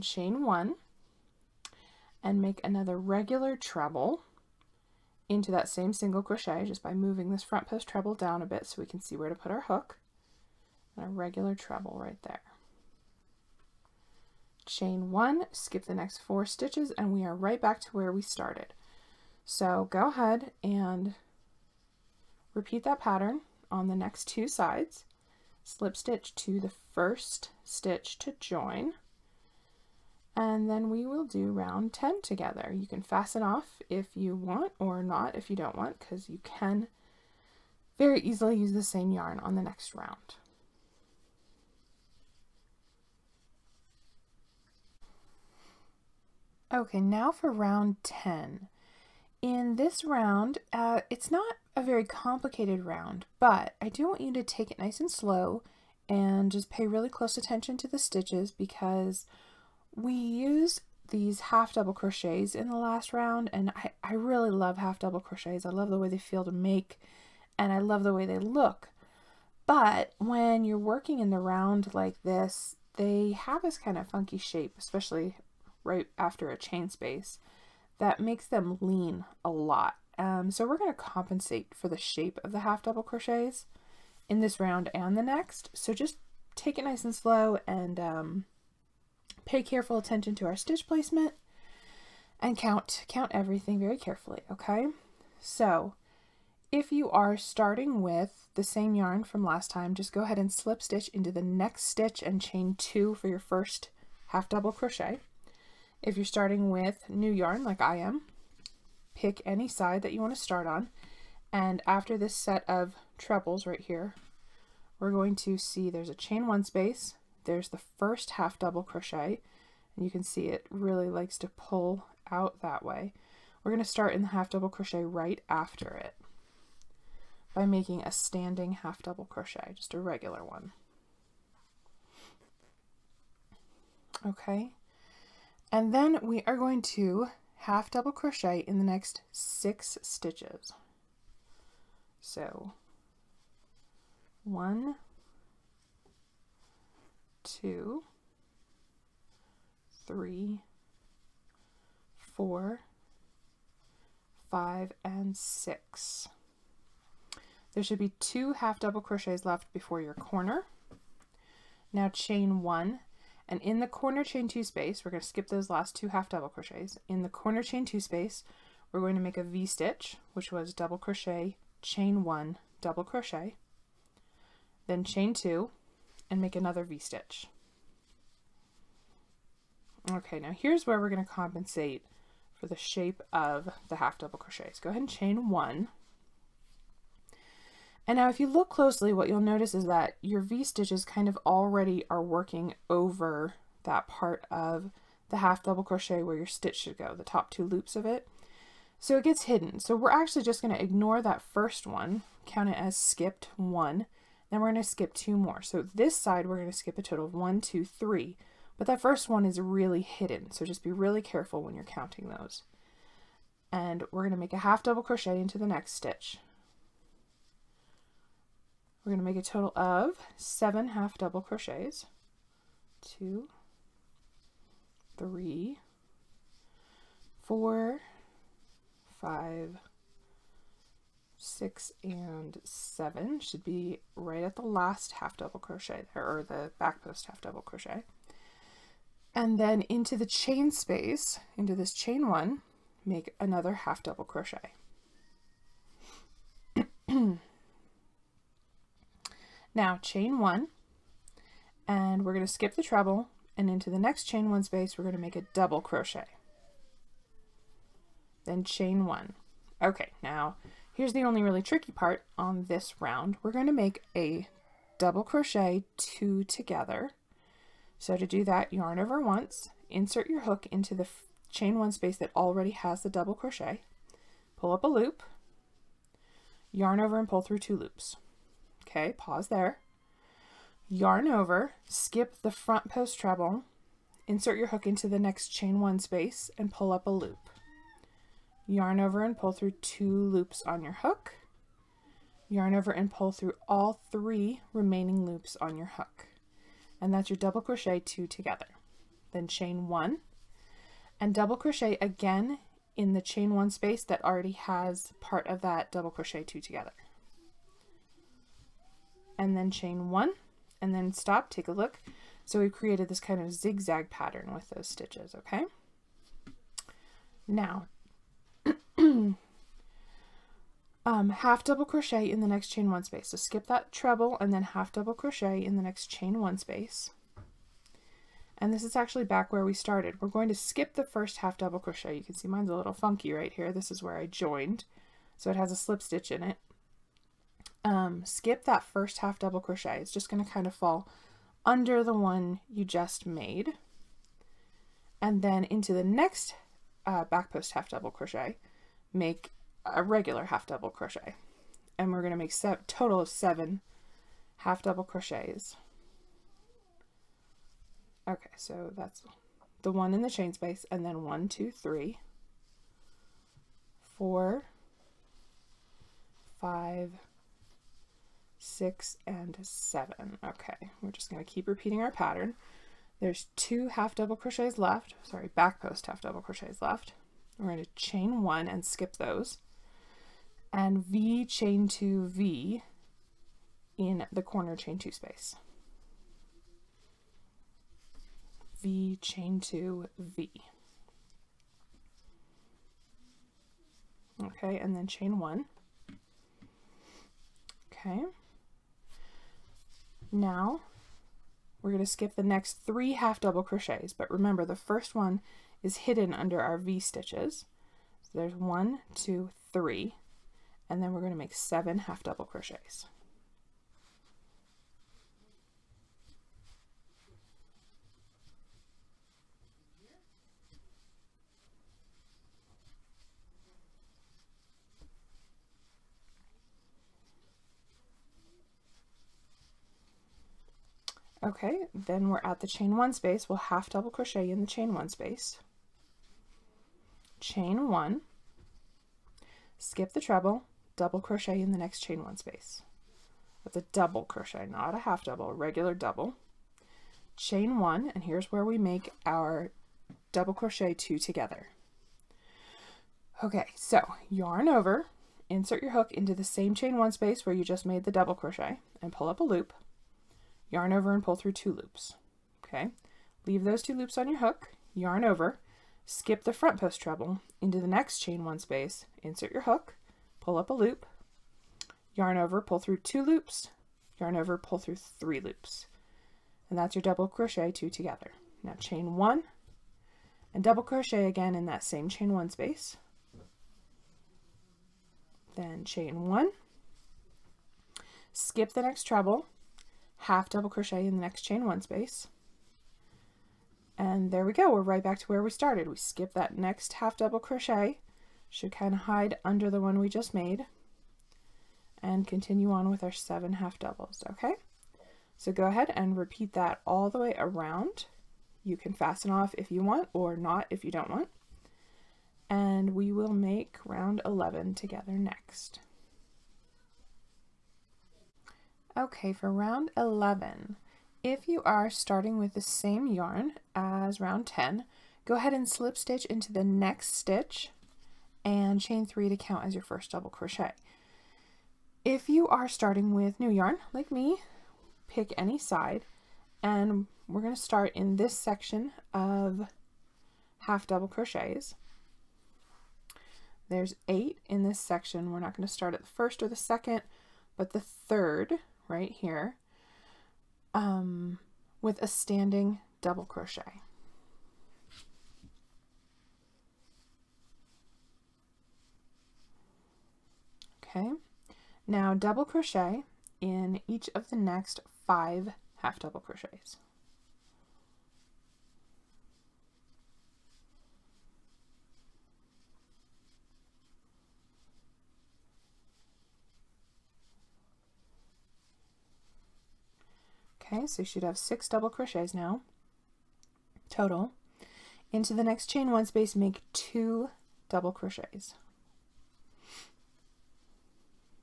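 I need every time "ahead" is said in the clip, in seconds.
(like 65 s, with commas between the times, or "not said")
20 s, 100 s, 184 s, 505 s, 525 s.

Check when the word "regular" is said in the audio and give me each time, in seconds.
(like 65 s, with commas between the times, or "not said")
2 s, 11 s, 129 s, 350 s, 445 s.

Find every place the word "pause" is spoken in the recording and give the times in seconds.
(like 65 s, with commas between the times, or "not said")
279 s.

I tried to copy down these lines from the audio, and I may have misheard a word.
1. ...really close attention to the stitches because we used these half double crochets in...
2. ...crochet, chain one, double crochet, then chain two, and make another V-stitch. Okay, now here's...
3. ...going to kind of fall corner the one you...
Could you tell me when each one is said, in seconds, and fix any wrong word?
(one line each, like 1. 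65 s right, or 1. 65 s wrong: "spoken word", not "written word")
1. 56 s right
2. 170 s right
3. 340 s wrong: "under", not "corner".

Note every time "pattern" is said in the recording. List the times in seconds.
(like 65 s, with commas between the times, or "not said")
22 s, 314 s, 372 s.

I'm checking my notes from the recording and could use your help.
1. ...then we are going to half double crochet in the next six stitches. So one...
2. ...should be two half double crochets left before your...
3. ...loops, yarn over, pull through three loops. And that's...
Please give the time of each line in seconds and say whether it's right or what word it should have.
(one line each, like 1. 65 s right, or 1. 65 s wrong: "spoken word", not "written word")
1. 135 s right
2. 157 s right
3. 473 s right.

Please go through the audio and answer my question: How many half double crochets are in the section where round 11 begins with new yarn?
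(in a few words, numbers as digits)
8.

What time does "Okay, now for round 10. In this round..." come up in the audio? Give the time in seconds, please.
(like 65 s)
46 s.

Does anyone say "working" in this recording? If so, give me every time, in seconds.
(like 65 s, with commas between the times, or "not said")
70 s, 192 s.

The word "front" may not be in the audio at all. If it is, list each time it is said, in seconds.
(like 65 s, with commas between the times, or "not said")
7 s, 282 s, 466 s.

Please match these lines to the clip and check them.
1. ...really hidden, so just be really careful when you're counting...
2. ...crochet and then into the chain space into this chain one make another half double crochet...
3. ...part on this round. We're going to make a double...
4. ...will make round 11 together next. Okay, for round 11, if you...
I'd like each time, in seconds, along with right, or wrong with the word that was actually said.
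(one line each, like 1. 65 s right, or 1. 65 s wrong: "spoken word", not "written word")
1. 209 s right
2. 237 s right
3. 261 s right
4. 513 s right.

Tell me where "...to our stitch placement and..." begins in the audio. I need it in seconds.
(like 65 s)
90 s.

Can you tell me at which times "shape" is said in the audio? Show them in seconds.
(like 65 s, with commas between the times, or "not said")
74 s, 81 s, 182 s.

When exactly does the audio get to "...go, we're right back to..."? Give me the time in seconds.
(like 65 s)
494 s.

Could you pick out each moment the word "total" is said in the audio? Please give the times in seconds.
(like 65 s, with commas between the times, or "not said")
207 s, 219 s, 352 s, 583 s.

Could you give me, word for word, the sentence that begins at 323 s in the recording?
So skip that treble and then half double crochet in the next chain one space.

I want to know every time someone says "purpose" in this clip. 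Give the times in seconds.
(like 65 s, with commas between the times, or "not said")
not said.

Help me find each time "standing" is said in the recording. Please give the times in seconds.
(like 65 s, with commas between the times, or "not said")
128 s, 552 s.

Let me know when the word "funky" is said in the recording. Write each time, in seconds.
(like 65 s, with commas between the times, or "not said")
74 s, 332 s.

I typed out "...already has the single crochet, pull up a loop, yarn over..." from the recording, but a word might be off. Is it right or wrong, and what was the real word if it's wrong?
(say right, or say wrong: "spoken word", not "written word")
wrong: "double", not "single".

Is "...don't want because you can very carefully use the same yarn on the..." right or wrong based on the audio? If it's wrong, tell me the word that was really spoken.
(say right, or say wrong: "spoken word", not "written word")
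wrong: "easily", not "carefully".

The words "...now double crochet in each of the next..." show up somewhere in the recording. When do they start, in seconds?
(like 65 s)
561 s.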